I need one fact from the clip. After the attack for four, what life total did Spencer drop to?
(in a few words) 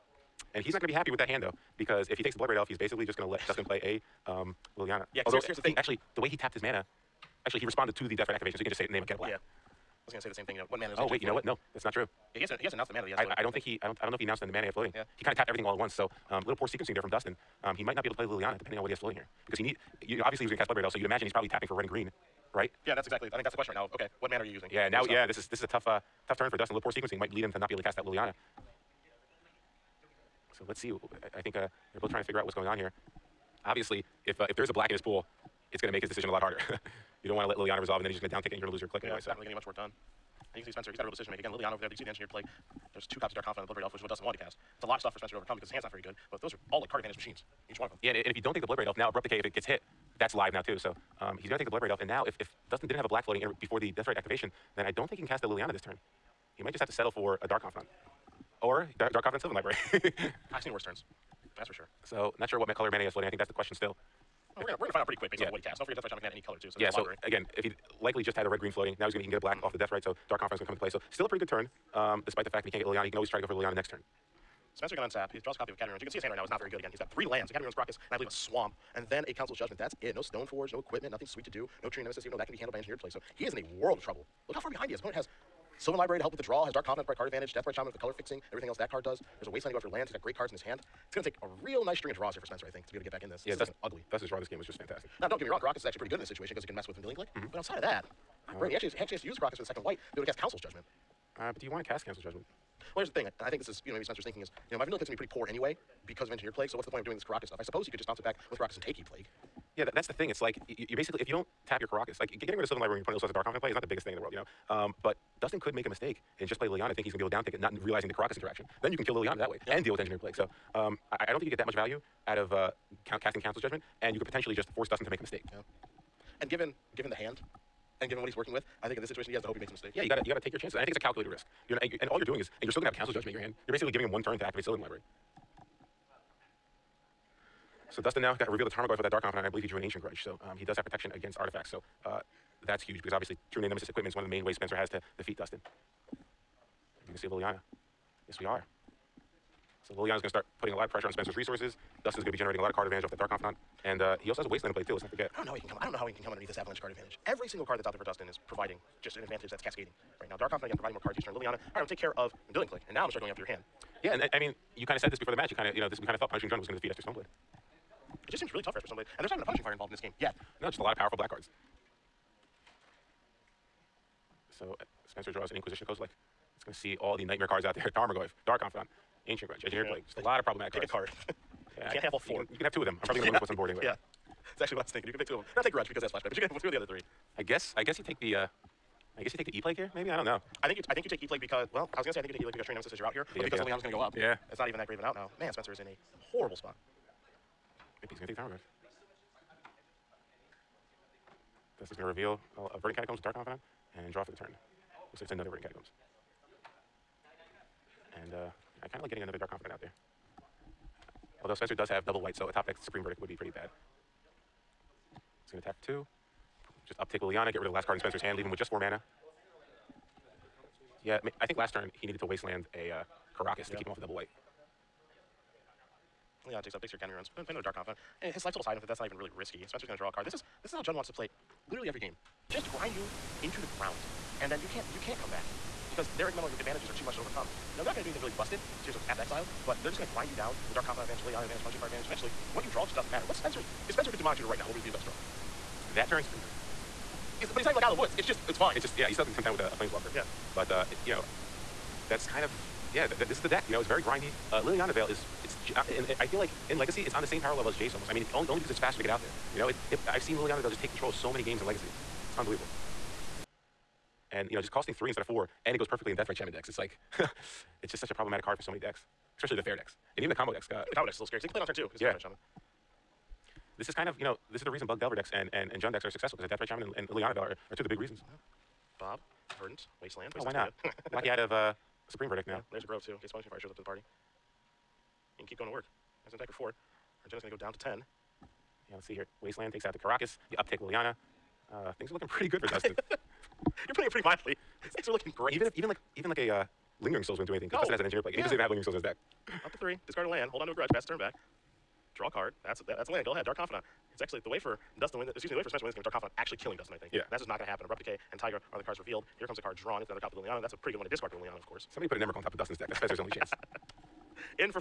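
10.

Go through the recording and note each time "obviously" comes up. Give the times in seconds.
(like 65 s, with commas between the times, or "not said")
20 s, 33 s, 143 s.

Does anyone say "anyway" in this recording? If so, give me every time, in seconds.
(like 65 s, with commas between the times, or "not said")
39 s, 105 s, 183 s.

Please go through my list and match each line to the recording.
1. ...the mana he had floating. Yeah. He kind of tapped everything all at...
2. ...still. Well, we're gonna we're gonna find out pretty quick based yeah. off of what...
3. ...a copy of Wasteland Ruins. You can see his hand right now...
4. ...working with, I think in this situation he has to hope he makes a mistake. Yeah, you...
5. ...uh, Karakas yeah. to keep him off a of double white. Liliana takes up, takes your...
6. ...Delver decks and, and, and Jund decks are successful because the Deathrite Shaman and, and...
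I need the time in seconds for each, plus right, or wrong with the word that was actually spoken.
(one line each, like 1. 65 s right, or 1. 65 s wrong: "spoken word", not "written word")
1. 14 s right
2. 63 s right
3. 75 s wrong: "Academy", not "Wasteland"
4. 128 s right
5. 222 s right
6. 275 s right.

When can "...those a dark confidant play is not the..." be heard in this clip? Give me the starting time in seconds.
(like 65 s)
113 s.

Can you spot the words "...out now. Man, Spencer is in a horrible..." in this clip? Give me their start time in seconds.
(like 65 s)
195 s.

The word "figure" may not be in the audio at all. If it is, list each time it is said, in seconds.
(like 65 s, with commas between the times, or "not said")
32 s.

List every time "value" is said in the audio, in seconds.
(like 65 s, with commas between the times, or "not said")
121 s.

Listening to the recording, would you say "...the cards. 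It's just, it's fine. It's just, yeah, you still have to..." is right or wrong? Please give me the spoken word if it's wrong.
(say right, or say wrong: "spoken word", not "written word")
wrong: "woods", not "cards".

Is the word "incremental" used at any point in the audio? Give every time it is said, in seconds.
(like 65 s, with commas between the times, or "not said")
236 s.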